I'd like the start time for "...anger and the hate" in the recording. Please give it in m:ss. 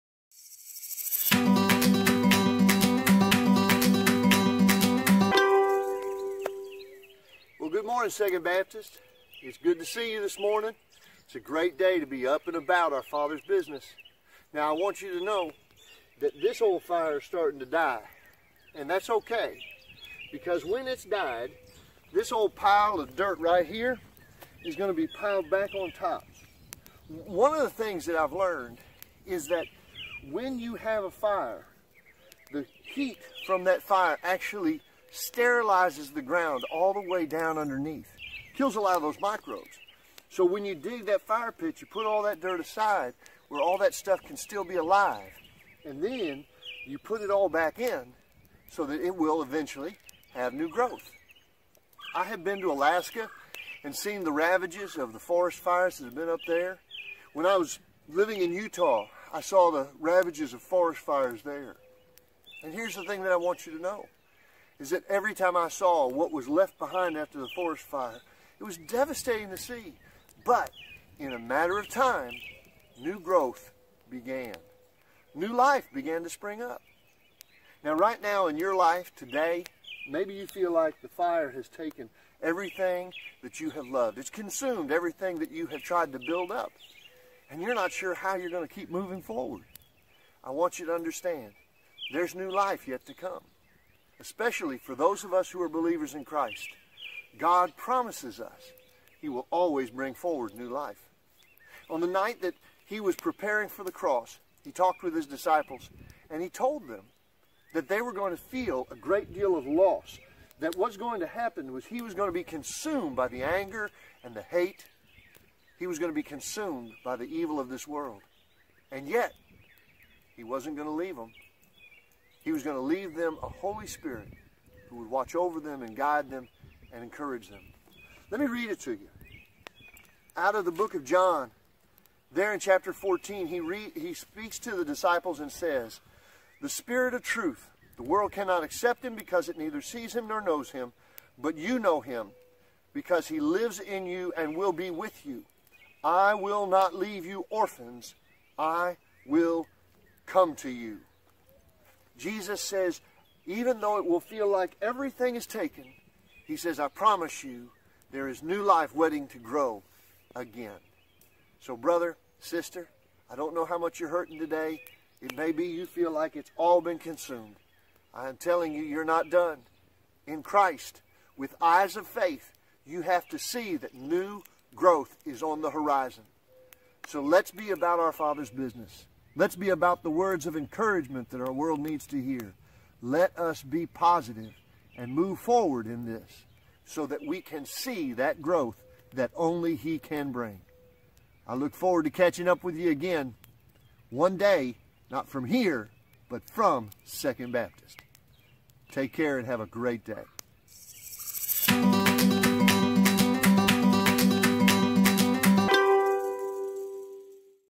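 1:53.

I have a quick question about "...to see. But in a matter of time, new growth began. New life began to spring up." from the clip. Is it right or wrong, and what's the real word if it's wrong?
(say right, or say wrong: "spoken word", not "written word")
right.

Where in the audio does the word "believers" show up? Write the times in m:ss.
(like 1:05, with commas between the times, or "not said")
1:35.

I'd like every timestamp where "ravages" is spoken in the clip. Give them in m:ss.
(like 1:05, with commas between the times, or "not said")
0:54, 0:59.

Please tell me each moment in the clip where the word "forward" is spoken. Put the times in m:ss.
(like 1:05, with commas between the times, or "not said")
1:29, 1:40, 3:05, 3:11.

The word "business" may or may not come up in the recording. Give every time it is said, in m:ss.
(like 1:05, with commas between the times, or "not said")
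0:13, 2:58.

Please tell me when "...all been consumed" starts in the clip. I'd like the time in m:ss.
2:46.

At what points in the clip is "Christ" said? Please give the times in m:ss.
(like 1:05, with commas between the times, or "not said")
1:36, 2:50.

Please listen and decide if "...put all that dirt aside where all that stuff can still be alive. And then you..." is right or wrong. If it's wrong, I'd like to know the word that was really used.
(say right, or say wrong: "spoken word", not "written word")
right.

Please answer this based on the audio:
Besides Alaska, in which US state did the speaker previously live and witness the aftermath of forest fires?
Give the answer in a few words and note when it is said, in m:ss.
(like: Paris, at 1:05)
Utah, at 0:58.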